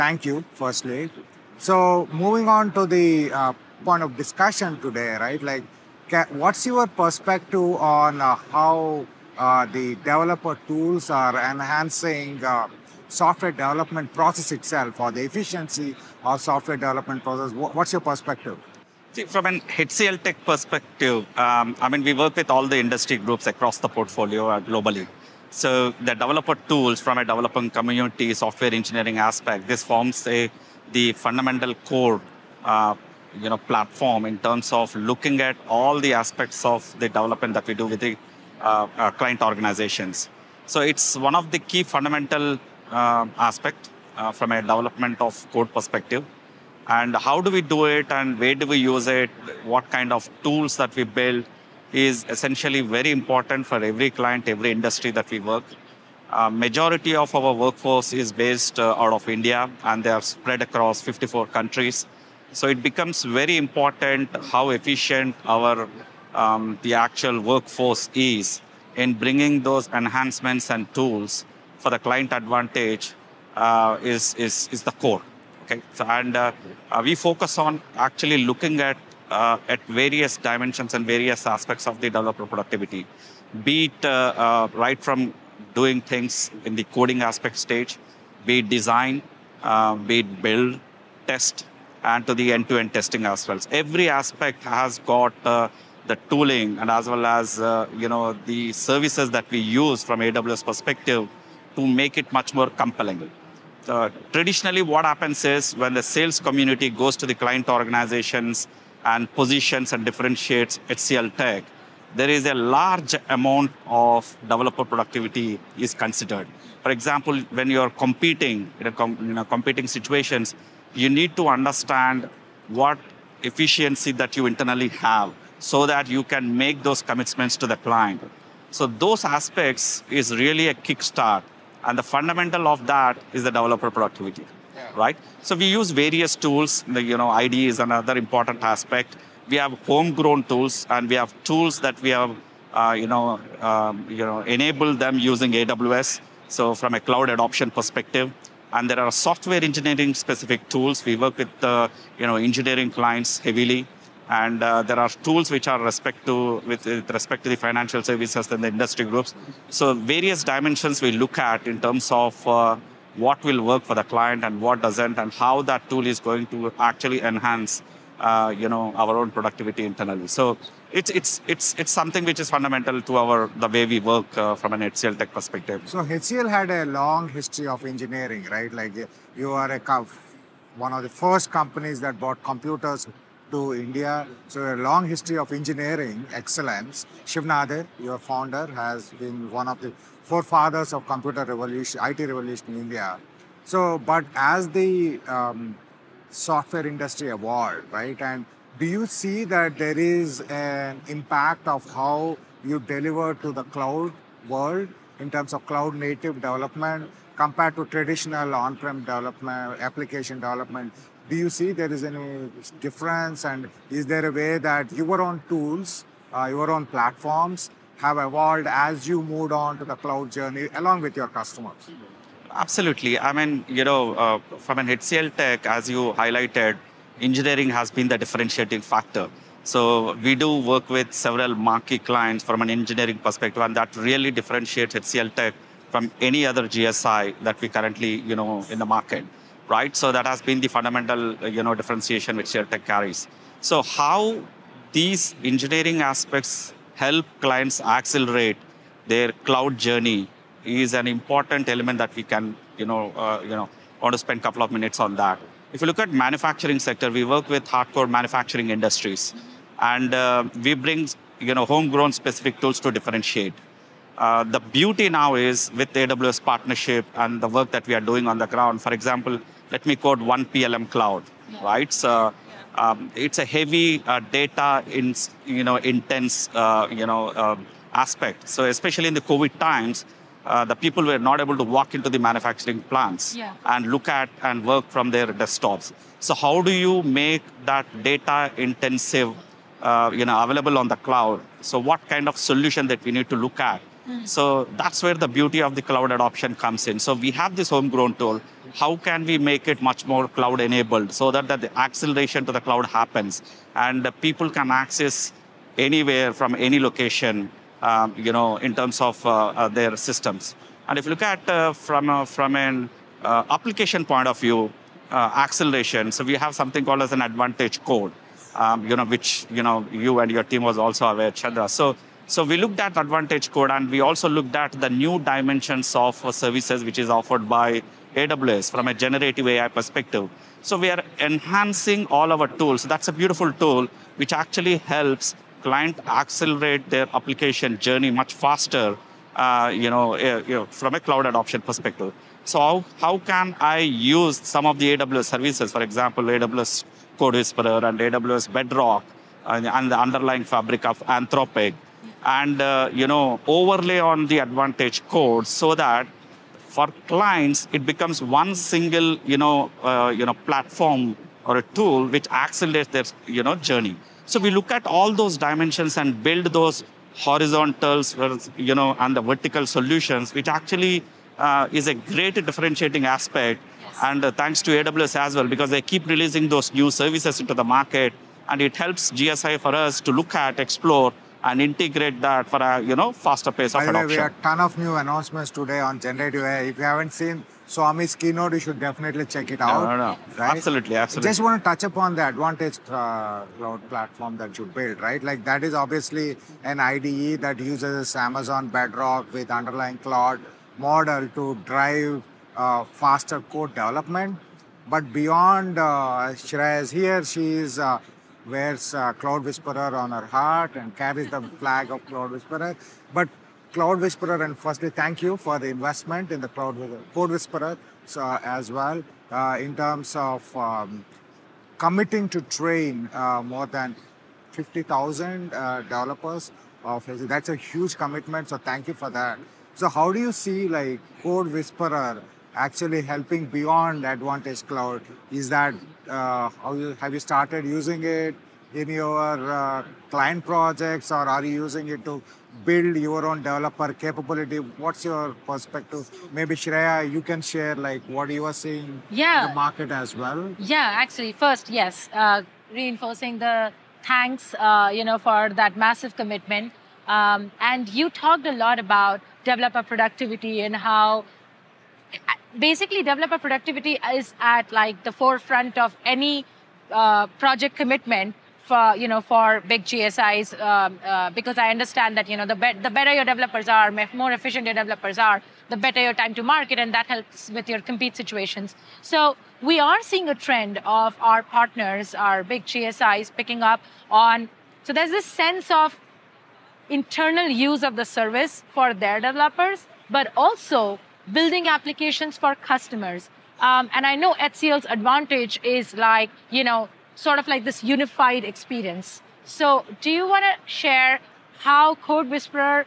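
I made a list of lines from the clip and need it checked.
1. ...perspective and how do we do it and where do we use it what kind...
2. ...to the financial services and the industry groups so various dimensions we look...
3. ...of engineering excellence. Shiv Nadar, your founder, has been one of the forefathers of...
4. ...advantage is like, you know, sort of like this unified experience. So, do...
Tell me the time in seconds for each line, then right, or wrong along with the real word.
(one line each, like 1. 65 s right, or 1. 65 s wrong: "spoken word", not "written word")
1. 45 s right
2. 157 s right
3. 185 s right
4. 494 s right.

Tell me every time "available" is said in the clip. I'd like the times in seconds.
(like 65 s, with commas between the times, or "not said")
290 s.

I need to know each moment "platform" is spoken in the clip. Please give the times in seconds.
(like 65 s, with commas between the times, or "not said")
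33 s, 216 s, 360 s, 393 s.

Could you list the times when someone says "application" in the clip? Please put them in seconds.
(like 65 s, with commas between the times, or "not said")
209 s, 313 s, 337 s, 491 s.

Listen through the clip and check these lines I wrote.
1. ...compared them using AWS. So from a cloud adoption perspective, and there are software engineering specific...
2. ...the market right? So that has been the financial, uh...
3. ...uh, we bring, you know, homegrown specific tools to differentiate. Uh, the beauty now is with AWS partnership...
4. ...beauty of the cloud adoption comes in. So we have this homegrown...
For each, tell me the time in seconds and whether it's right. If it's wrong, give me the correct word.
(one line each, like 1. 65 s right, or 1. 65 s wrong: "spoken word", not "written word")
1. 144 s wrong: "enabled", not "compared"
2. 238 s wrong: "fundamental", not "financial"
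3. 260 s right
4. 295 s right.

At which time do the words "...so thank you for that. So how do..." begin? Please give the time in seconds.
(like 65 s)
428 s.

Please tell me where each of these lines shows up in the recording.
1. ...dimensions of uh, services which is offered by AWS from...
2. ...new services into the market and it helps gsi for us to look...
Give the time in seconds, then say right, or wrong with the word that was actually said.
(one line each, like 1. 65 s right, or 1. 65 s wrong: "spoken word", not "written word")
1. 325 s right
2. 376 s right.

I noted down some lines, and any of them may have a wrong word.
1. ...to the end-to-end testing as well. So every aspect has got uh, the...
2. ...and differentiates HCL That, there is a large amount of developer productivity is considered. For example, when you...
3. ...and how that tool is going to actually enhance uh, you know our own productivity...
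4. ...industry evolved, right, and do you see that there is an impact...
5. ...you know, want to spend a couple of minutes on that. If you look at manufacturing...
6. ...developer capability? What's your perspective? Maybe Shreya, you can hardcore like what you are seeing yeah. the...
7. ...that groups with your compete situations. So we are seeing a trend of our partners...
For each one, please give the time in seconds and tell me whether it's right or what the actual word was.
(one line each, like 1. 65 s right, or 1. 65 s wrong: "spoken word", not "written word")
1. 92 s right
2. 109 s wrong: "Tech", not "That"
3. 165 s right
4. 196 s right
5. 253 s right
6. 443 s wrong: "share", not "hardcore"
7. 476 s wrong: "helps", not "groups".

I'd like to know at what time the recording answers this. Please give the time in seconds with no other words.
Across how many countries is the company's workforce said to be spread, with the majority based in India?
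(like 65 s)
61 s.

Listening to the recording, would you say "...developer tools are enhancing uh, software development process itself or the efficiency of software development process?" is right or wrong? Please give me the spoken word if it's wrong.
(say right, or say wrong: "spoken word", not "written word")
right.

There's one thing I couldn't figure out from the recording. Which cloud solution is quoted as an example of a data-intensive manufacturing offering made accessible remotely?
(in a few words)
PLM cloud.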